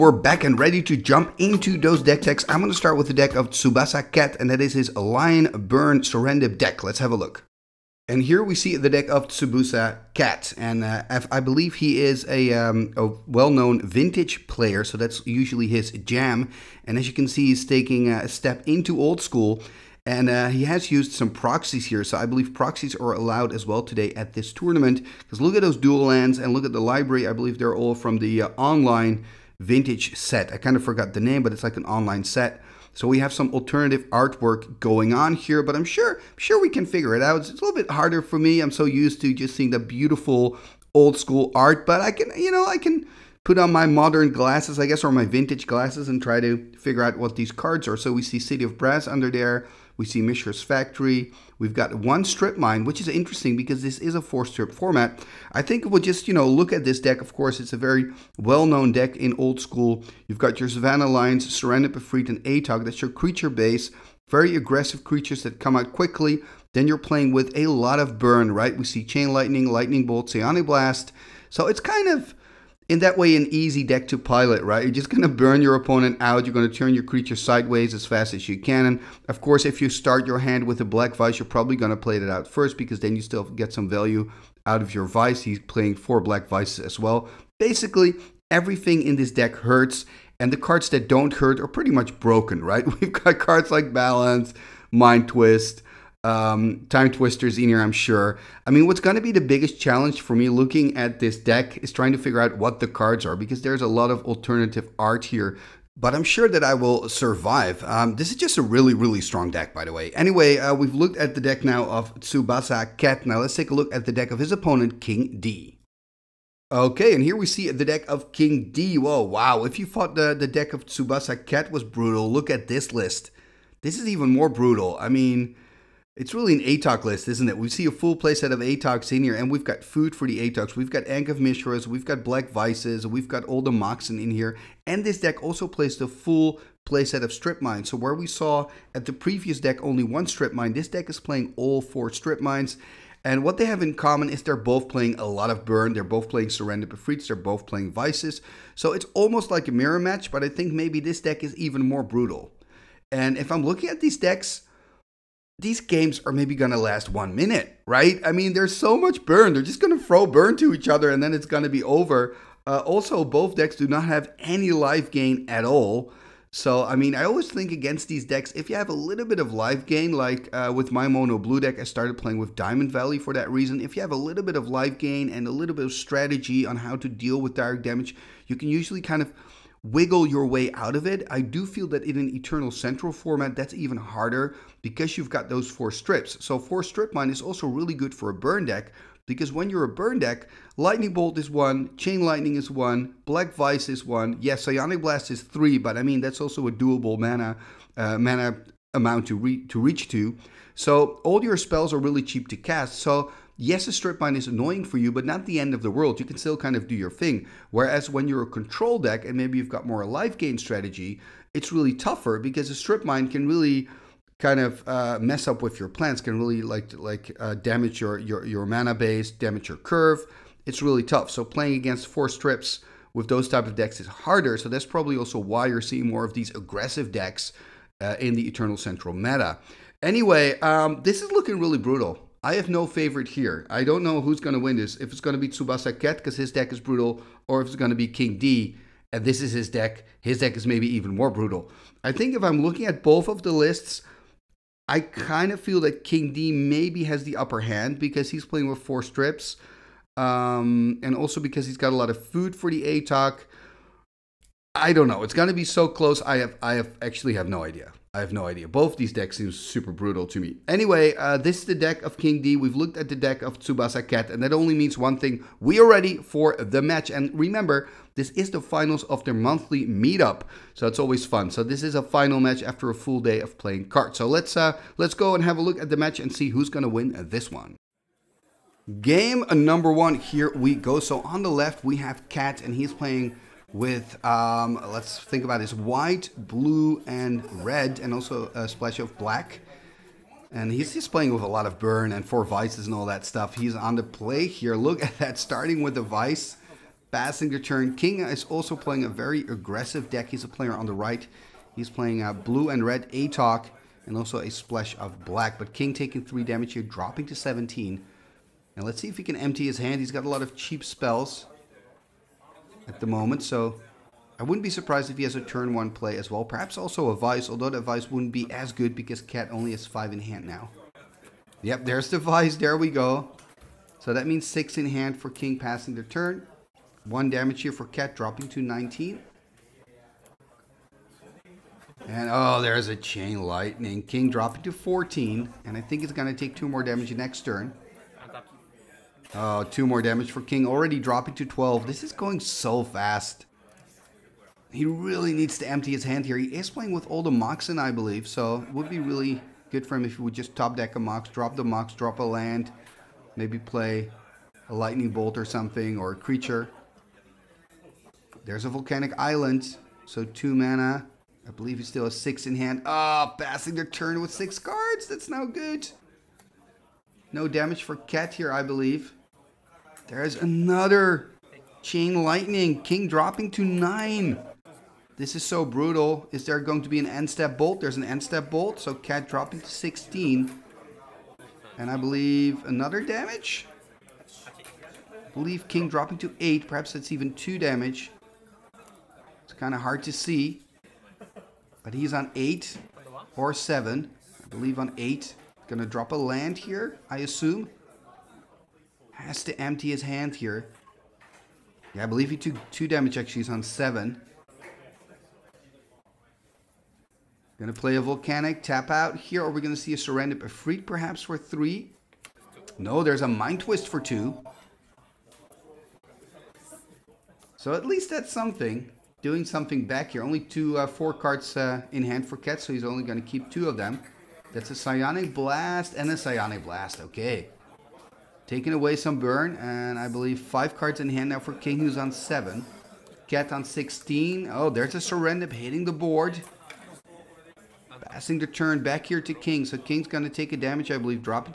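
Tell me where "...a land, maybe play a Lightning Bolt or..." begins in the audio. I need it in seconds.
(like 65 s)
352 s.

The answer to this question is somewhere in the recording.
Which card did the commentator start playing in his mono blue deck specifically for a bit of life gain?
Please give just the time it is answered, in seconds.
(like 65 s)
172 s.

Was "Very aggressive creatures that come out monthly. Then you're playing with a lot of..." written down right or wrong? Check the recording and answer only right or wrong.
wrong.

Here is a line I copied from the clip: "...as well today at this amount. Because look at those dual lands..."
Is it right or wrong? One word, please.
wrong.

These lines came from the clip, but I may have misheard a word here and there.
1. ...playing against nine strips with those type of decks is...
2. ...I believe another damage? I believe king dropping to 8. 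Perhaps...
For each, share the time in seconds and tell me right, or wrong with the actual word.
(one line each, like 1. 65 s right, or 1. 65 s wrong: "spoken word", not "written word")
1. 221 s wrong: "four", not "nine"
2. 381 s right.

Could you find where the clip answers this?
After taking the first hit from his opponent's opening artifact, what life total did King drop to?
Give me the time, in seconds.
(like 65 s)
307 s.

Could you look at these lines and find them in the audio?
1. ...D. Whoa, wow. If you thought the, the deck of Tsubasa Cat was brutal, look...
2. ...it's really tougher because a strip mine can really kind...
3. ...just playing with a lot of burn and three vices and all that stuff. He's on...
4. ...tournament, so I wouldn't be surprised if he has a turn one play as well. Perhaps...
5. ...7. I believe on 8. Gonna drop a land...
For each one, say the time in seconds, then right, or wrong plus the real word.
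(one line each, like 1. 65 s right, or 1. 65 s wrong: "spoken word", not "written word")
1. 118 s right
2. 211 s right
3. 290 s wrong: "four", not "three"
4. 313 s wrong: "moment", not "tournament"
5. 393 s right.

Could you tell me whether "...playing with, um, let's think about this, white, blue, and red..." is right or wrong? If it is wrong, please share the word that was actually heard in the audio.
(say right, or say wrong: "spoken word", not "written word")
right.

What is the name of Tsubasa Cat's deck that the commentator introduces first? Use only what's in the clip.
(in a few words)
Lion Burn Serendib.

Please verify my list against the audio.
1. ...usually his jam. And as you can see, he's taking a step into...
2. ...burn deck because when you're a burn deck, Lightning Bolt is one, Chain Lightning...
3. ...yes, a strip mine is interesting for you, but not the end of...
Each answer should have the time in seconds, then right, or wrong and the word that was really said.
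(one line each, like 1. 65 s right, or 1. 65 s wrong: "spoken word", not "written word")
1. 15 s right
2. 188 s right
3. 203 s wrong: "annoying", not "interesting".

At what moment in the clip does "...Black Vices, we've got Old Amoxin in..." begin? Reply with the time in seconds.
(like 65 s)
132 s.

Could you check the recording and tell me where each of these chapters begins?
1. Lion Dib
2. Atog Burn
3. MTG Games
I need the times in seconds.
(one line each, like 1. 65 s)
1. 7 s
2. 116 s
3. 279 s.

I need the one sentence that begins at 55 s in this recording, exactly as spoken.
I think we'll just, you know, look at this deck.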